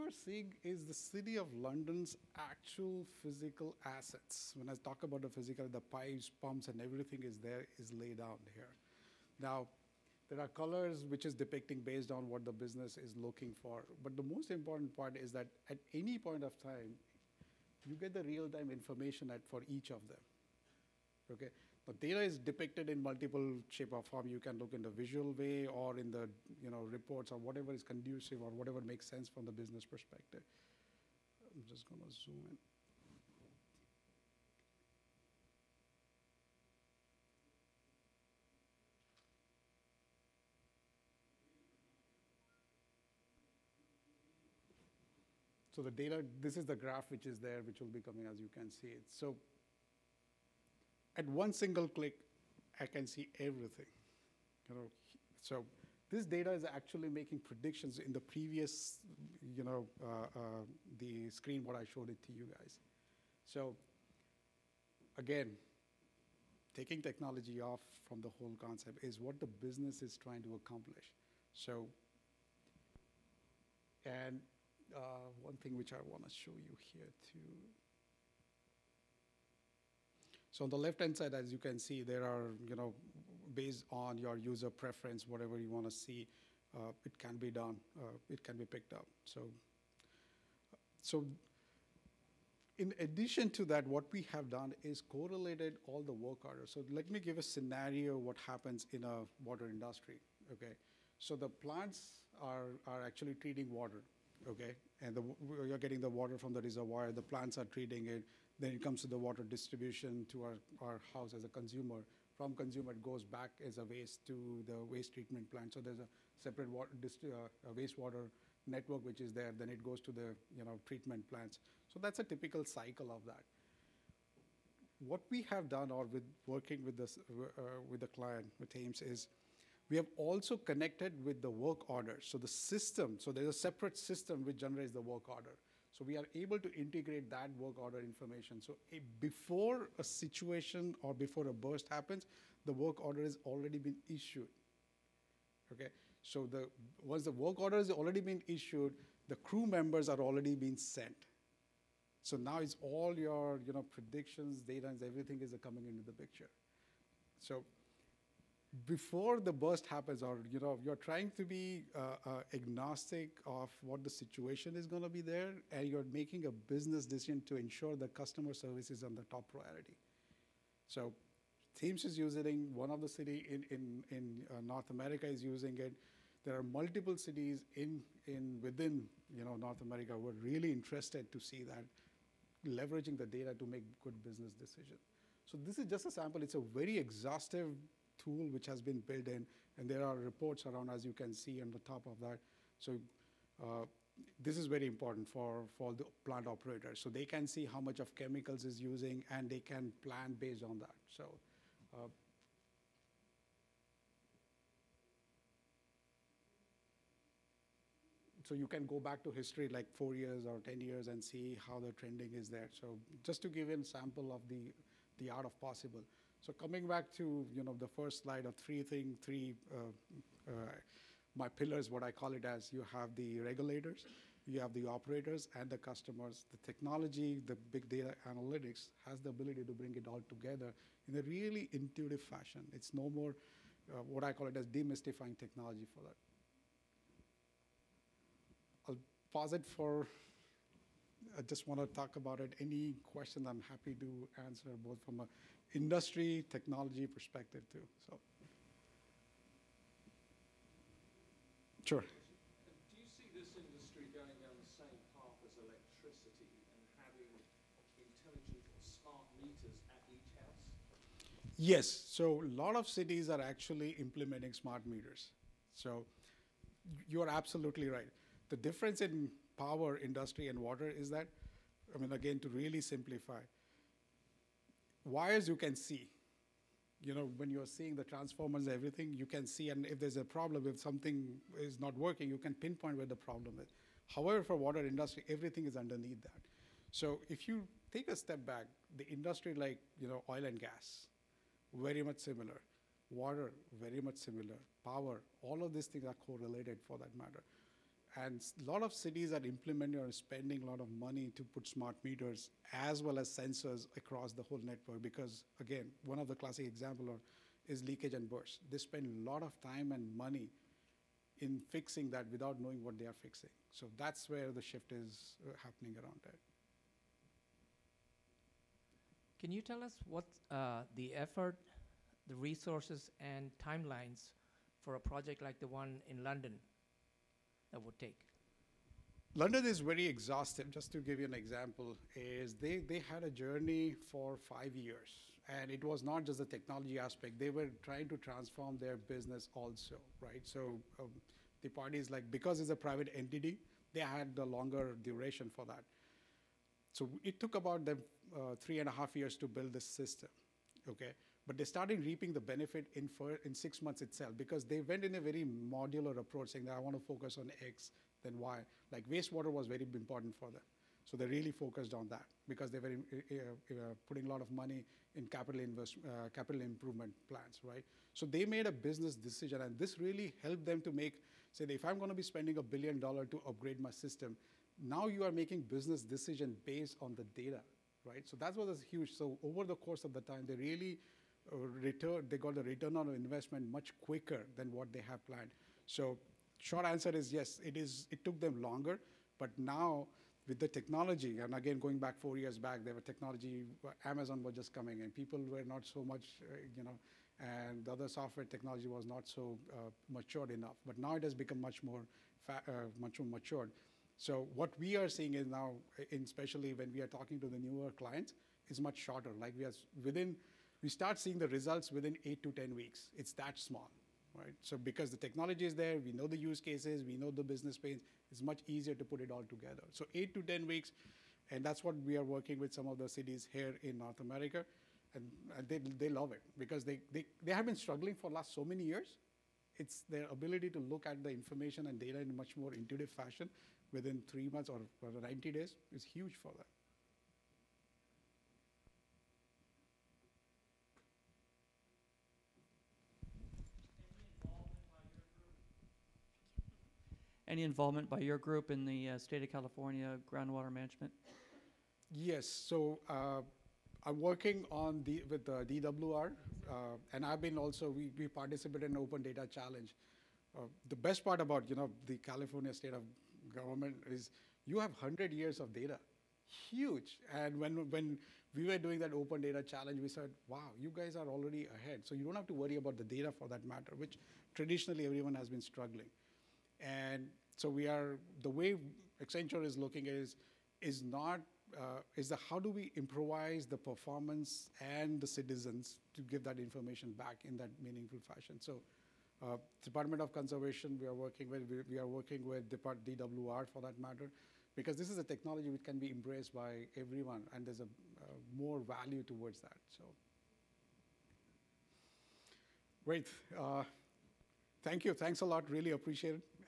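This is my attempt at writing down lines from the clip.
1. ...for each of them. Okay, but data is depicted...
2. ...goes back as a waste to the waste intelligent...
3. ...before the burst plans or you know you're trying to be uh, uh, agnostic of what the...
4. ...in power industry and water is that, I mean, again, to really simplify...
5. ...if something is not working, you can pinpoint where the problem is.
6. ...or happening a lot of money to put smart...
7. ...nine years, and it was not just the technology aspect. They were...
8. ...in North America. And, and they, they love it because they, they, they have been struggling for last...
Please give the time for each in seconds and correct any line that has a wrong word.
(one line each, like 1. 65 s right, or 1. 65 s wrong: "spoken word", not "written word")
1. 19 s right
2. 113 s wrong: "treatment", not "intelligent"
3. 158 s wrong: "happens", not "plans"
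4. 269 s right
5. 280 s right
6. 300 s wrong: "spending", not "happening"
7. 334 s wrong: "five", not "nine"
8. 423 s right.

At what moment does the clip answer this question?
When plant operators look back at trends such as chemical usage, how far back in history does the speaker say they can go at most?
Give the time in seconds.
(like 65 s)
210 s.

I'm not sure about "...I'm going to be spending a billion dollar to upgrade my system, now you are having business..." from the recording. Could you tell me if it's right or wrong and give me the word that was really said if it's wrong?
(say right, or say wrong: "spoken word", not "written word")
wrong: "making", not "having".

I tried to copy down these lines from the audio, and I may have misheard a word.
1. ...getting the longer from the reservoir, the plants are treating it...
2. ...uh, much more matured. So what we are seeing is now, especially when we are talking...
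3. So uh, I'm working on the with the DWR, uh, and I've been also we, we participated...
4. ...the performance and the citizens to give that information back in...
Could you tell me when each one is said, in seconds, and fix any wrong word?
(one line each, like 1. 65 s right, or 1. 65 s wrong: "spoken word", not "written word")
1. 105 s wrong: "water", not "longer"
2. 402 s right
3. 452 s right
4. 483 s right.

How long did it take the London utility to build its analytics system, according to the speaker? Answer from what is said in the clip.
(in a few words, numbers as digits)
3.5 years.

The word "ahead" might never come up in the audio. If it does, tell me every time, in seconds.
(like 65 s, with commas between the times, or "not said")
471 s.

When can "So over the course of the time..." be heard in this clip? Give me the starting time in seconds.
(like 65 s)
379 s.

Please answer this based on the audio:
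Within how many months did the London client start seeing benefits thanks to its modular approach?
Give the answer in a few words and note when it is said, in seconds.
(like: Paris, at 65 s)
6 months, at 353 s.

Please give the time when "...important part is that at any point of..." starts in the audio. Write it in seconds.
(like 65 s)
14 s.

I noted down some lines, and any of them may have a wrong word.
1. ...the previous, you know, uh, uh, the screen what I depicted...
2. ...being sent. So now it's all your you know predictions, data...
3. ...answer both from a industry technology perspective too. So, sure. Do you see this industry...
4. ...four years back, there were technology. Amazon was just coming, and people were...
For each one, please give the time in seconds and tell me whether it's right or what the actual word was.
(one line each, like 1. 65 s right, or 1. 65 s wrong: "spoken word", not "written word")
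1. 58 s wrong: "showed", not "depicted"
2. 150 s right
3. 244 s right
4. 392 s right.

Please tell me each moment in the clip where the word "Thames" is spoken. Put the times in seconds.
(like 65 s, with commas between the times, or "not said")
128 s, 171 s.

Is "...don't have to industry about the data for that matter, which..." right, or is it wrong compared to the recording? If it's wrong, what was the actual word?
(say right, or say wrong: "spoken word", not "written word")
wrong: "worry", not "industry".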